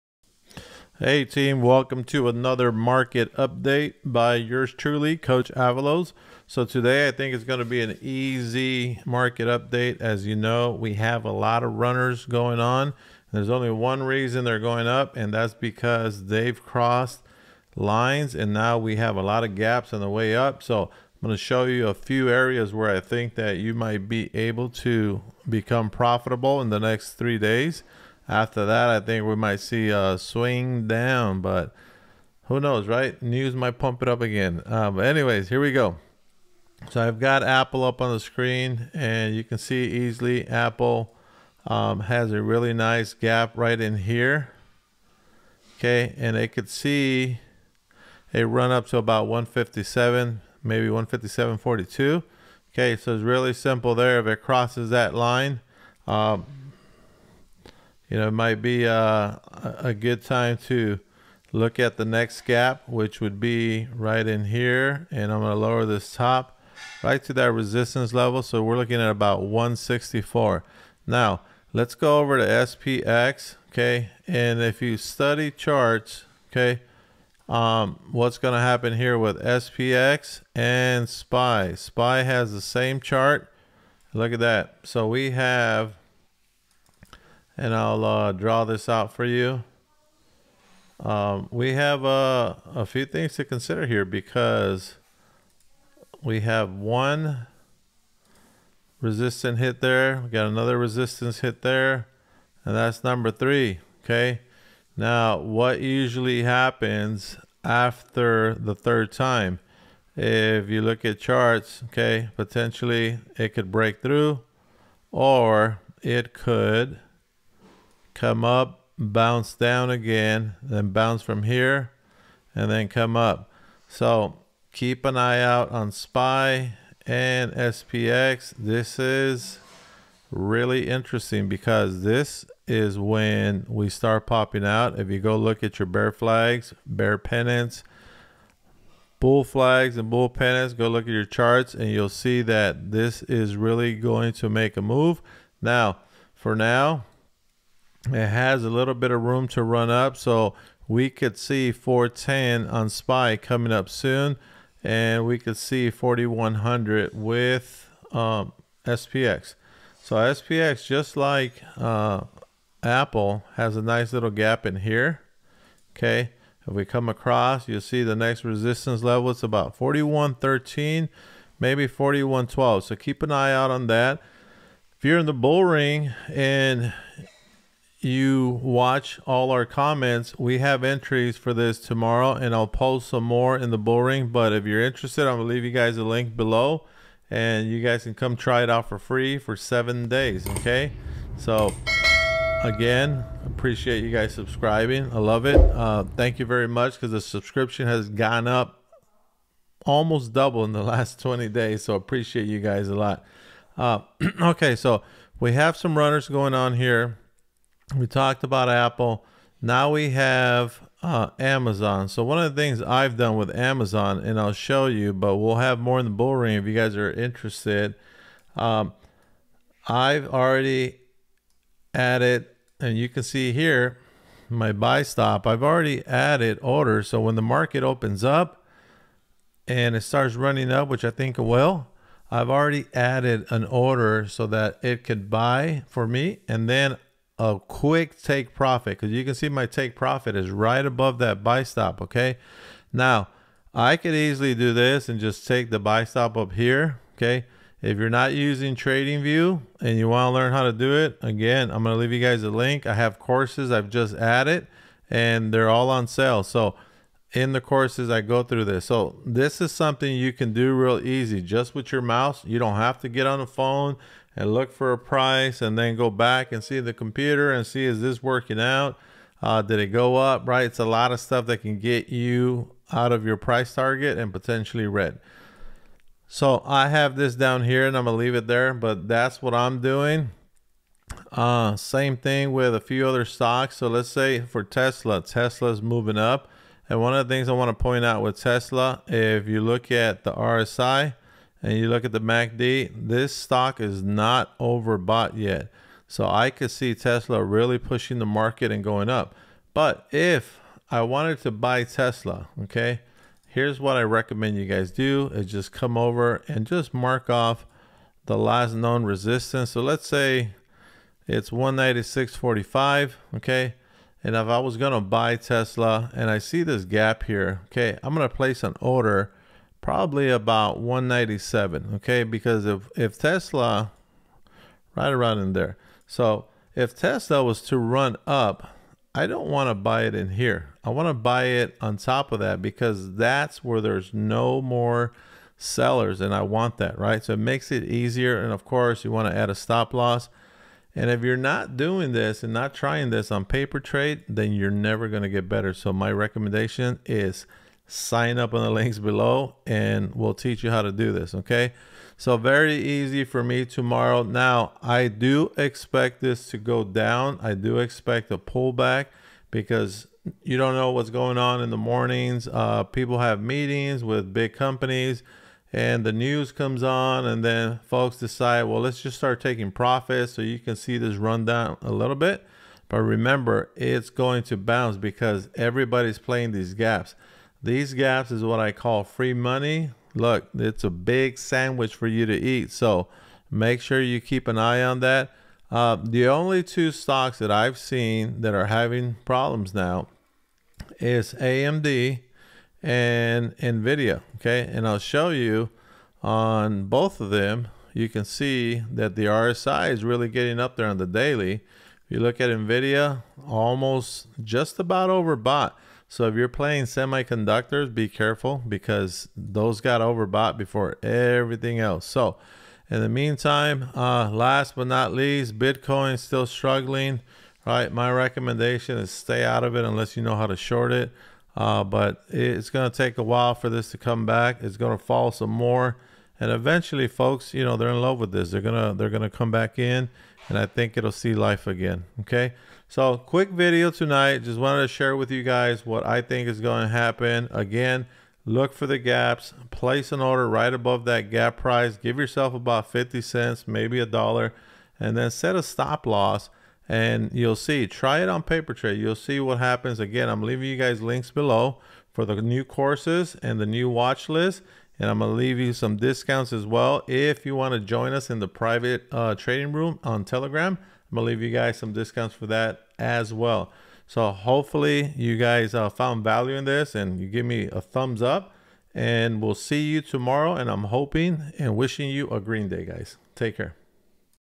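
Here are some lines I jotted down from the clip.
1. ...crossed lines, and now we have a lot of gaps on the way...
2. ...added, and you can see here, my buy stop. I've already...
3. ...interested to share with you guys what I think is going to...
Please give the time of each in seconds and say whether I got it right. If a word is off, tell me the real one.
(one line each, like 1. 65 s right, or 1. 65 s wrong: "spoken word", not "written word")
1. 16 s right
2. 221 s right
3. 434 s wrong: "wanted", not "interested".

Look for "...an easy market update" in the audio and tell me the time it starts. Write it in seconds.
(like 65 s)
7 s.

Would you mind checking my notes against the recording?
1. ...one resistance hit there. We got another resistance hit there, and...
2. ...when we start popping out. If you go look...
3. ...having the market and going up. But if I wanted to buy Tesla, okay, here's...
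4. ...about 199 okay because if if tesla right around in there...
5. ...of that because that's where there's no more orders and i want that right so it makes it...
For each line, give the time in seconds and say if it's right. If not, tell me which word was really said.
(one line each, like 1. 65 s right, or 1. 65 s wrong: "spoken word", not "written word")
1. 96 s right
2. 132 s right
3. 297 s wrong: "pushing", not "having"
4. 320 s wrong: "197", not "199"
5. 332 s wrong: "sellers", not "orders".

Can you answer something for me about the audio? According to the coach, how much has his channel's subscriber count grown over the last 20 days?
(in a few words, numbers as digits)
almost double.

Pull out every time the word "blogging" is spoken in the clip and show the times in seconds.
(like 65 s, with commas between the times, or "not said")
not said.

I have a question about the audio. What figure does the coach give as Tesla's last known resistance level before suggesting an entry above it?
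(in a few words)
196.45.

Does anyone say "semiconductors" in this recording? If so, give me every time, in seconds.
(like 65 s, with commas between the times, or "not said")
406 s.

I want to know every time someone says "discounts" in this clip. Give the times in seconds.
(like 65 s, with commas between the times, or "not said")
455 s, 461 s.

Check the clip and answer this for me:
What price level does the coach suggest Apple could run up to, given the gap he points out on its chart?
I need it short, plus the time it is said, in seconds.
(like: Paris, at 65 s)
157.42, at 50 s.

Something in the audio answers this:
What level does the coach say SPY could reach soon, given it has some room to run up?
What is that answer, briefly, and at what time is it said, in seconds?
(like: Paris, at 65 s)
410, at 151 s.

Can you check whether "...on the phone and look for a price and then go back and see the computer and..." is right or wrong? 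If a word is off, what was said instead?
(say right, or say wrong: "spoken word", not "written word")
right.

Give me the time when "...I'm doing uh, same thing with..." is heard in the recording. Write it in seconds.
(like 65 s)
279 s.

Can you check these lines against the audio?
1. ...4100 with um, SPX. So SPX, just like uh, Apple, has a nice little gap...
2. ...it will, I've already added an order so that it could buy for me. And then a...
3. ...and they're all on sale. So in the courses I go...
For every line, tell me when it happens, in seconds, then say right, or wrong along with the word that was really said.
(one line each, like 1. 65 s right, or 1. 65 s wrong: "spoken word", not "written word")
1. 155 s right
2. 231 s right
3. 255 s right.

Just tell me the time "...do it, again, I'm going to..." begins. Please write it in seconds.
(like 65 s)
250 s.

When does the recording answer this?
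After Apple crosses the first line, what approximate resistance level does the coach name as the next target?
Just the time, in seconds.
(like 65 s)
69 s.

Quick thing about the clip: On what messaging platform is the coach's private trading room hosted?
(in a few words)
Telegram.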